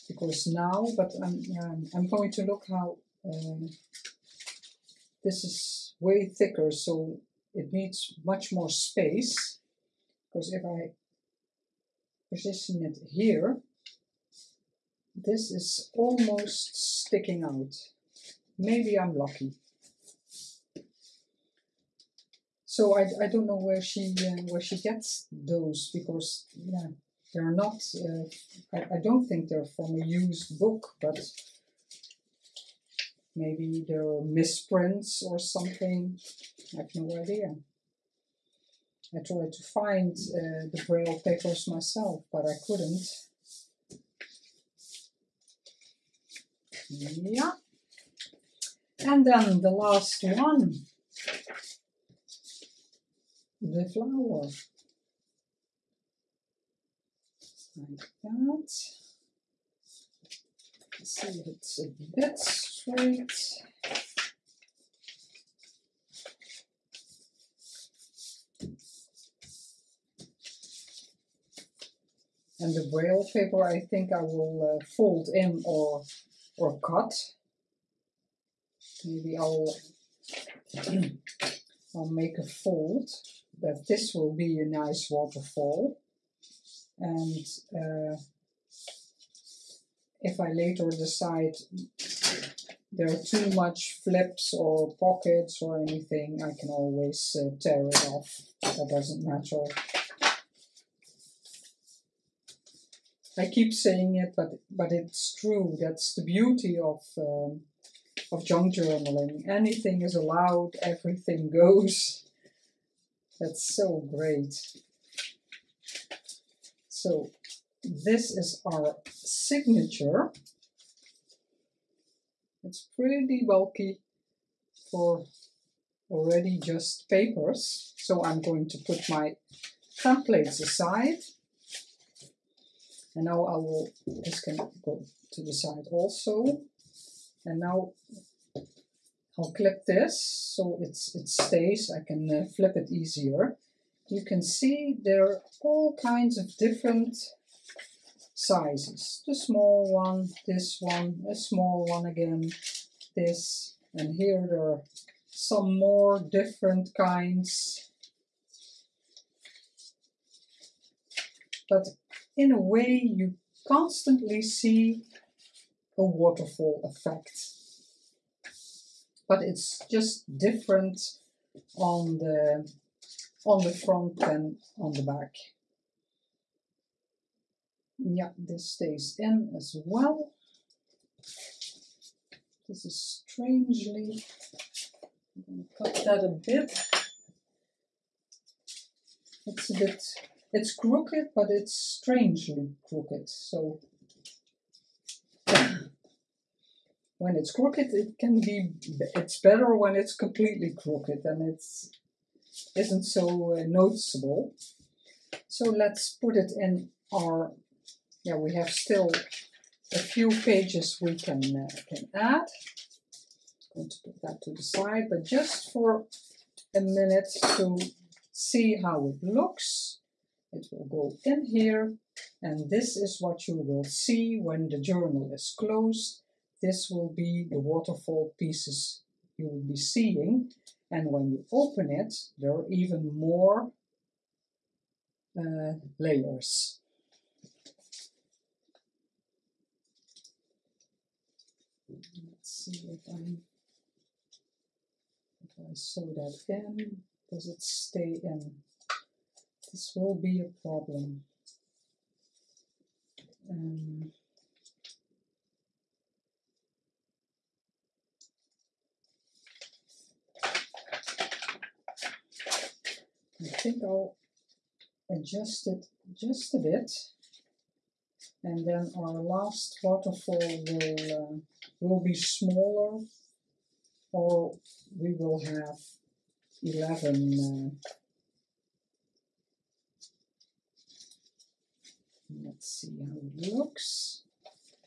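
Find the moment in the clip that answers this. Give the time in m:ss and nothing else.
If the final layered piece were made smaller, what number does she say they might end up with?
4:36.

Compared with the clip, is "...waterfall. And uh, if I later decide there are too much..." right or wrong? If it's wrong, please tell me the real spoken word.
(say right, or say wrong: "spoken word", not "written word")
right.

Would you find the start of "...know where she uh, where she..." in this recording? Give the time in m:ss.
0:23.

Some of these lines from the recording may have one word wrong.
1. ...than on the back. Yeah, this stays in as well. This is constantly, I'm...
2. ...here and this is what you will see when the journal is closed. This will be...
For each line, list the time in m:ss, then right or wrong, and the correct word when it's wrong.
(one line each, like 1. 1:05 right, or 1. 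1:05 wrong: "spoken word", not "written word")
1. 2:54 wrong: "strangely", not "constantly"
2. 3:41 right.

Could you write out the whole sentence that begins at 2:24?
You can see there are all kinds of different sizes.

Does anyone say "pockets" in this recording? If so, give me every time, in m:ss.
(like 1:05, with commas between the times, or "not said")
1:34.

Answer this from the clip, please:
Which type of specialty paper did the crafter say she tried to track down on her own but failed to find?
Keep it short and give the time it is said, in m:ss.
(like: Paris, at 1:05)
Braille papers, at 0:40.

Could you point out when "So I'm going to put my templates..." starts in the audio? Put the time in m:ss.
2:07.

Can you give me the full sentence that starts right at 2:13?
And now I will, this can go to the side also.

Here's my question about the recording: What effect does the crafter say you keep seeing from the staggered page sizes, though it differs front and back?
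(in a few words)
Waterfall effect.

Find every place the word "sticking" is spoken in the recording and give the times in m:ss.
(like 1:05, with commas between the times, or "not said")
0:17.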